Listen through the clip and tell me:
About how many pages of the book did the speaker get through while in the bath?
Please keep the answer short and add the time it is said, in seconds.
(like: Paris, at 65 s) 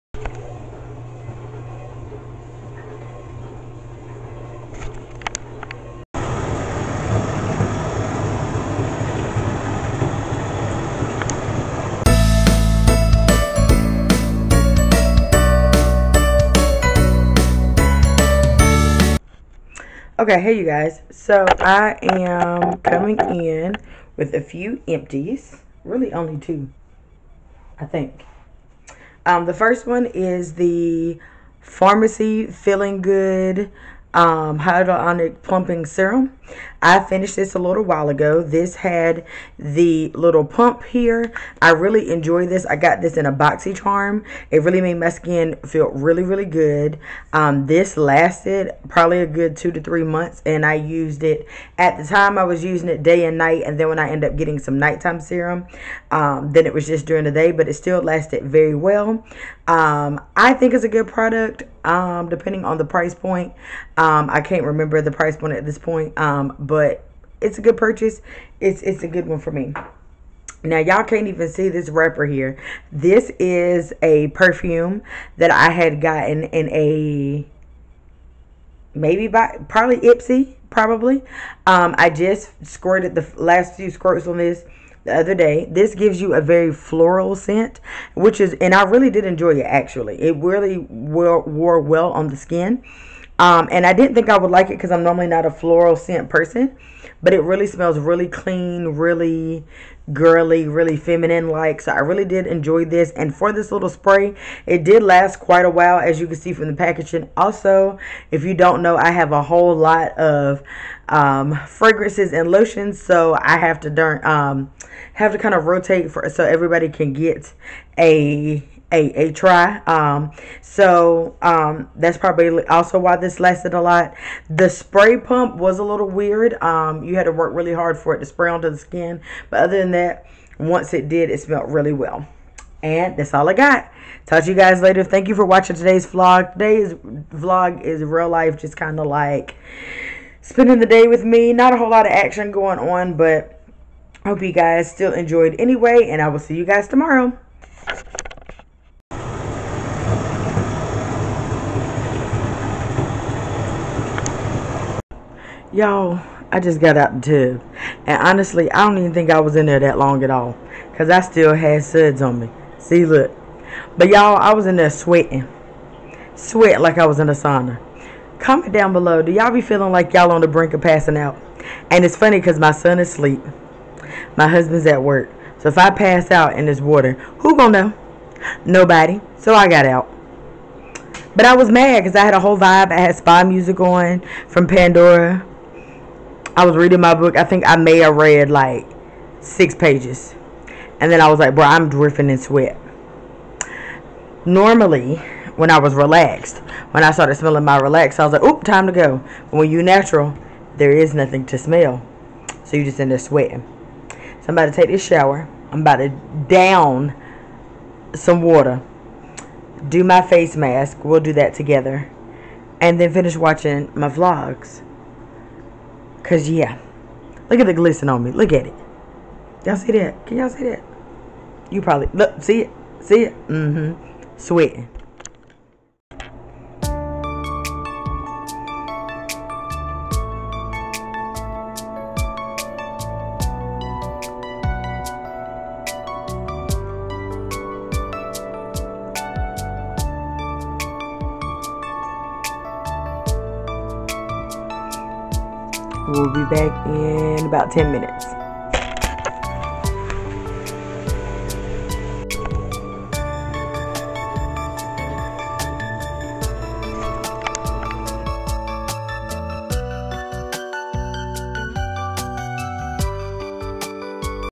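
6, at 189 s.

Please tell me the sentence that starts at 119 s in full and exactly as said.
Um, so um, that's probably also why this lasted a lot.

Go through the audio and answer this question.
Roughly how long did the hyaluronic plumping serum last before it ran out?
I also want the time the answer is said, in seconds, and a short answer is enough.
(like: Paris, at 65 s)
2 to 3 months, at 49 s.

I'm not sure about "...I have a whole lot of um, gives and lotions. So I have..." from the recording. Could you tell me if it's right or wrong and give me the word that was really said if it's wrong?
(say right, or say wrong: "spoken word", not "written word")
wrong: "fragrances", not "gives".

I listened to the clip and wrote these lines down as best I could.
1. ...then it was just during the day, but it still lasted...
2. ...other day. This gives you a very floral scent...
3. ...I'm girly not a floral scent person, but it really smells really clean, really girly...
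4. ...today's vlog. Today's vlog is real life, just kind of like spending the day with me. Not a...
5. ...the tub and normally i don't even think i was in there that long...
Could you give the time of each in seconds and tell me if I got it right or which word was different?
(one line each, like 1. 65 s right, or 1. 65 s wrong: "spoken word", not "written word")
1. 56 s right
2. 85 s right
3. 94 s wrong: "normally", not "girly"
4. 135 s right
5. 157 s wrong: "honestly", not "normally".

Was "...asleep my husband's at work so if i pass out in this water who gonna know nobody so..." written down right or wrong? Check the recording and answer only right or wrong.
right.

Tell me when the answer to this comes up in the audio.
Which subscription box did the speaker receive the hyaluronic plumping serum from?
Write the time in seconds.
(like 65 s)
43 s.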